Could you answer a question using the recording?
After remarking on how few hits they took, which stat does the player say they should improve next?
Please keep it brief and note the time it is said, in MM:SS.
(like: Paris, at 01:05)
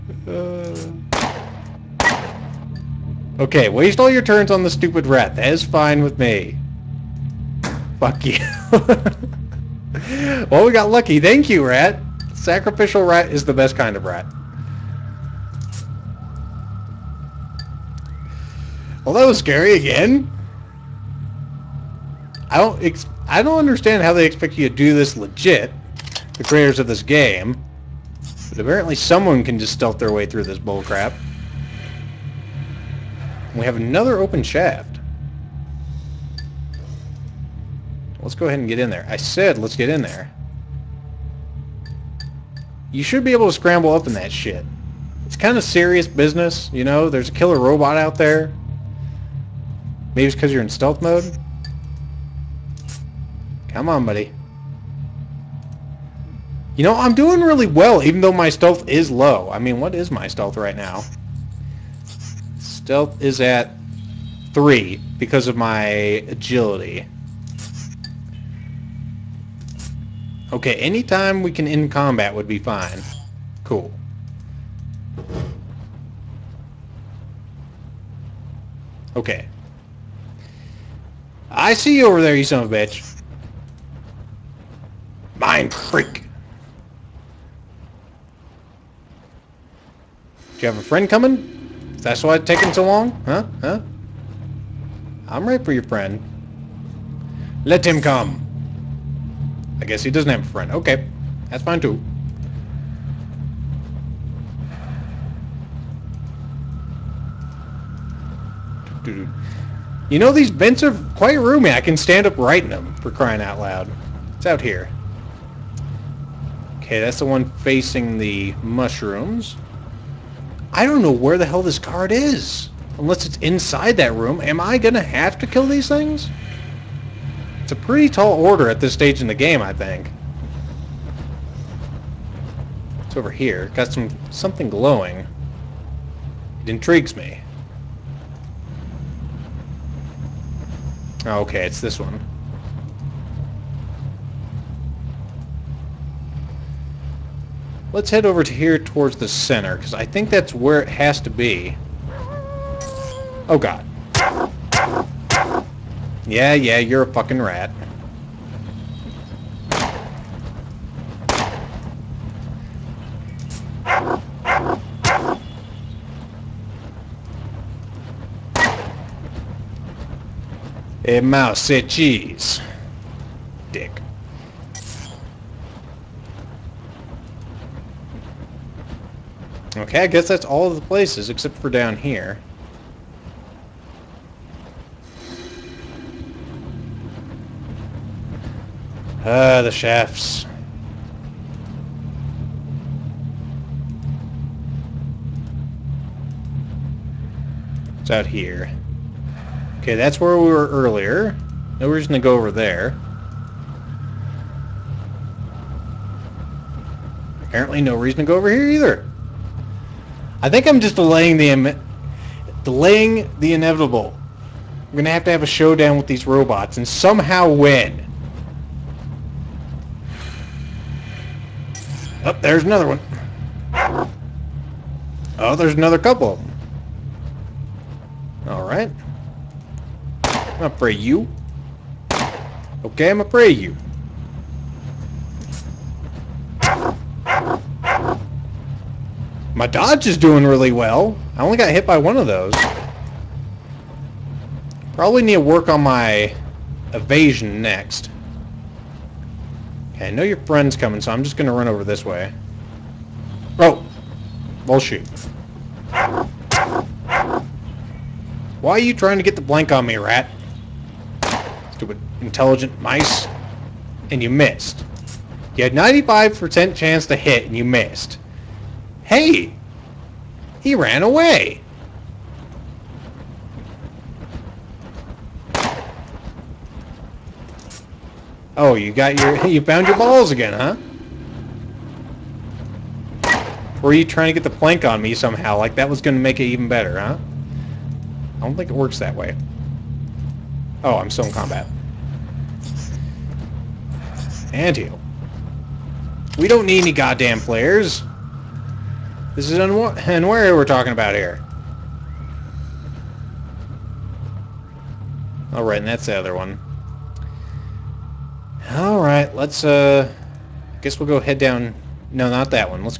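evasion, at 04:05.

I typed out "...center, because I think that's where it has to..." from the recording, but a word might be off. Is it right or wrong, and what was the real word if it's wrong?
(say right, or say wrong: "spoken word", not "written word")
right.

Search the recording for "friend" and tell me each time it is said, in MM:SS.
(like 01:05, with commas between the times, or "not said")
01:30, 01:35, 01:40, 04:10.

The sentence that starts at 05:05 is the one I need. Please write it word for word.
Alright, and that's the other one.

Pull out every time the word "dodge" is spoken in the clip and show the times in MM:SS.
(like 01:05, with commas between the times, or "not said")
03:59.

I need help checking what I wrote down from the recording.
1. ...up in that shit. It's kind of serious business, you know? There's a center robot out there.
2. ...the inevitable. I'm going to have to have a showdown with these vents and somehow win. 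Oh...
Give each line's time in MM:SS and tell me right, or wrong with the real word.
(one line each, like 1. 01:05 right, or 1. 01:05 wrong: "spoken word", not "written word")
1. 00:43 wrong: "killer", not "center"
2. 03:33 wrong: "robots", not "vents".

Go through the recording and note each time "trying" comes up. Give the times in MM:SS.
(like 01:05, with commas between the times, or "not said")
04:18, 04:44.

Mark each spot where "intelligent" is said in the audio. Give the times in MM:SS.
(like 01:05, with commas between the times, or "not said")
04:22.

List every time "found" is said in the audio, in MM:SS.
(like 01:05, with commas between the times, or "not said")
04:39.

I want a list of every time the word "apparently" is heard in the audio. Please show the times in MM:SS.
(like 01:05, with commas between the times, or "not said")
00:28, 03:27.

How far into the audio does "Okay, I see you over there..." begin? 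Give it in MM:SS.
01:19.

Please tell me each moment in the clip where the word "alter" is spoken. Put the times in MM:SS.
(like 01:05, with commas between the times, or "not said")
not said.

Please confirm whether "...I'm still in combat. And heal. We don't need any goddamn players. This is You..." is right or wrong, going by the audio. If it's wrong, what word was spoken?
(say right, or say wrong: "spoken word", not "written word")
wrong: "Unwary", not "You".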